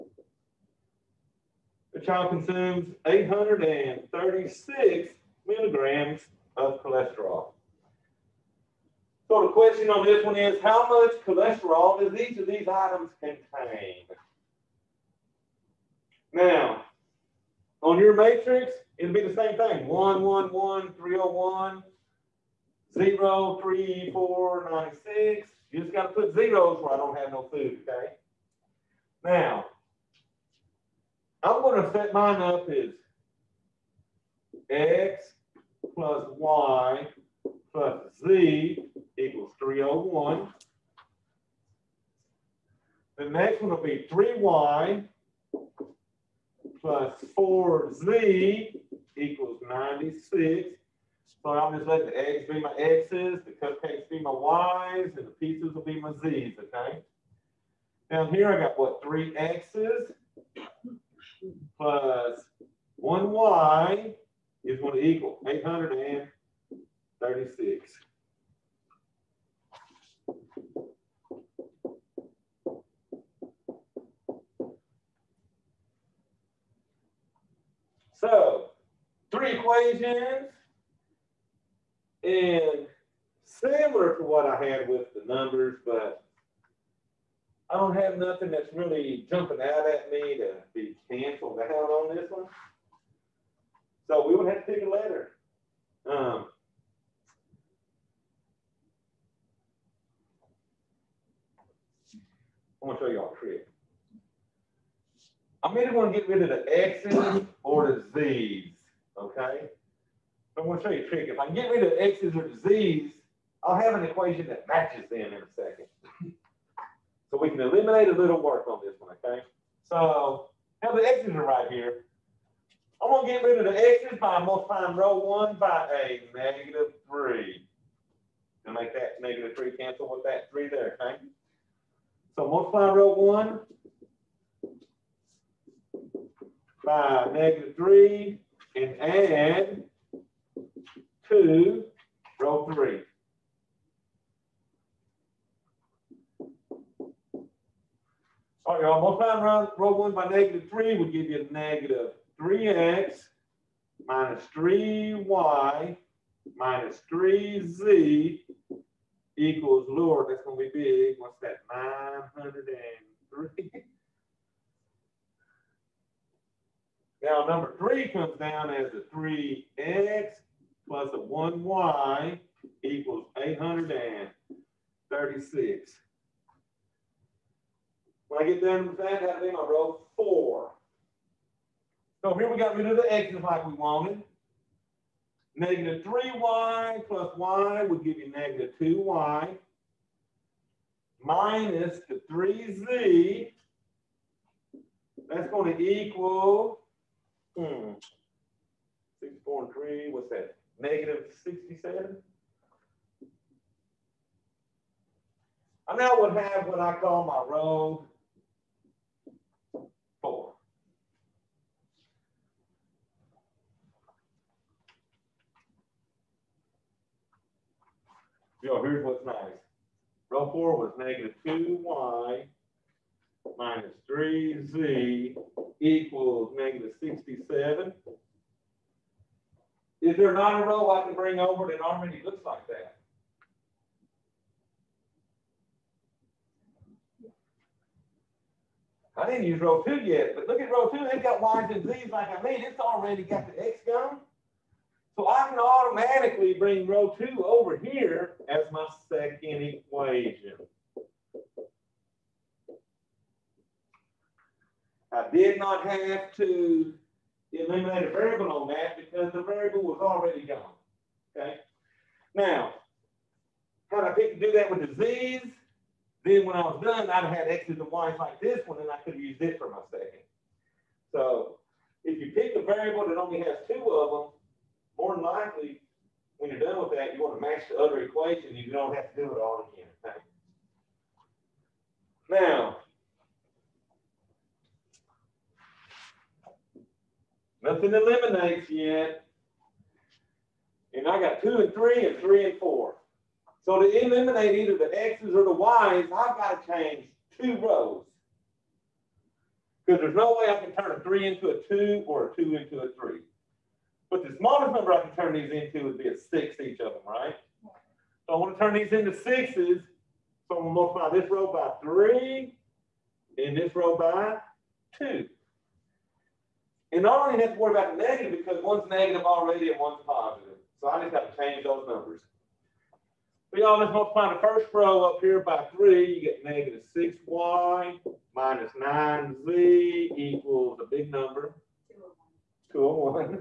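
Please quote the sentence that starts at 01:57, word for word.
so we can eliminate a little work on this one, okay?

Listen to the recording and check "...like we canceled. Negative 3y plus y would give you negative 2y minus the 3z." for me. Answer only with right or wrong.
wrong.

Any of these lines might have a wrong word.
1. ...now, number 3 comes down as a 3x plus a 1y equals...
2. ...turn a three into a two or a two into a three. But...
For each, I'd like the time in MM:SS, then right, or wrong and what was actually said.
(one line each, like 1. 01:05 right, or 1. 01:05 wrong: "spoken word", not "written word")
1. 02:47 right
2. 05:00 right.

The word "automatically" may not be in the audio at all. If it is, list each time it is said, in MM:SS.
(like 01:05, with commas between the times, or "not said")
04:05.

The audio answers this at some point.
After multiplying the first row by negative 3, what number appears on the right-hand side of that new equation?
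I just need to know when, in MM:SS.
02:41.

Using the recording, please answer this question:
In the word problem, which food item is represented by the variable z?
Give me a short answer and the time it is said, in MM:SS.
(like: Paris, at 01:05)
pizzas, at 00:55.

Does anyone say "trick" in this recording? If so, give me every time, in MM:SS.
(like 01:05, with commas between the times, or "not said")
01:43, 01:51.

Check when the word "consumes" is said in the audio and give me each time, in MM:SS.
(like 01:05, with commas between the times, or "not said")
00:02.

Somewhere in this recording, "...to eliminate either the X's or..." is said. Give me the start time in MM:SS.
04:53.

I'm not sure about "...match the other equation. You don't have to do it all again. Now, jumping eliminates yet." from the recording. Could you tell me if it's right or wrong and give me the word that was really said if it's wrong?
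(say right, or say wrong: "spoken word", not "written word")
wrong: "nothing", not "jumping".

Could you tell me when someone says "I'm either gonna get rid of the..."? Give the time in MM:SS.
01:45.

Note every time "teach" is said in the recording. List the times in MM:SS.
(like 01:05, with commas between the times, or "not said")
not said.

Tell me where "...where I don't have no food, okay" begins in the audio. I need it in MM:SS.
00:26.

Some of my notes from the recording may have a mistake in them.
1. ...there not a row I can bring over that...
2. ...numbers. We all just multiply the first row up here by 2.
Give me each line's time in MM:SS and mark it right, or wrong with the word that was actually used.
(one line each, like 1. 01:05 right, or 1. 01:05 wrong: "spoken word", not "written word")
1. 03:50 right
2. 05:21 wrong: "3", not "2".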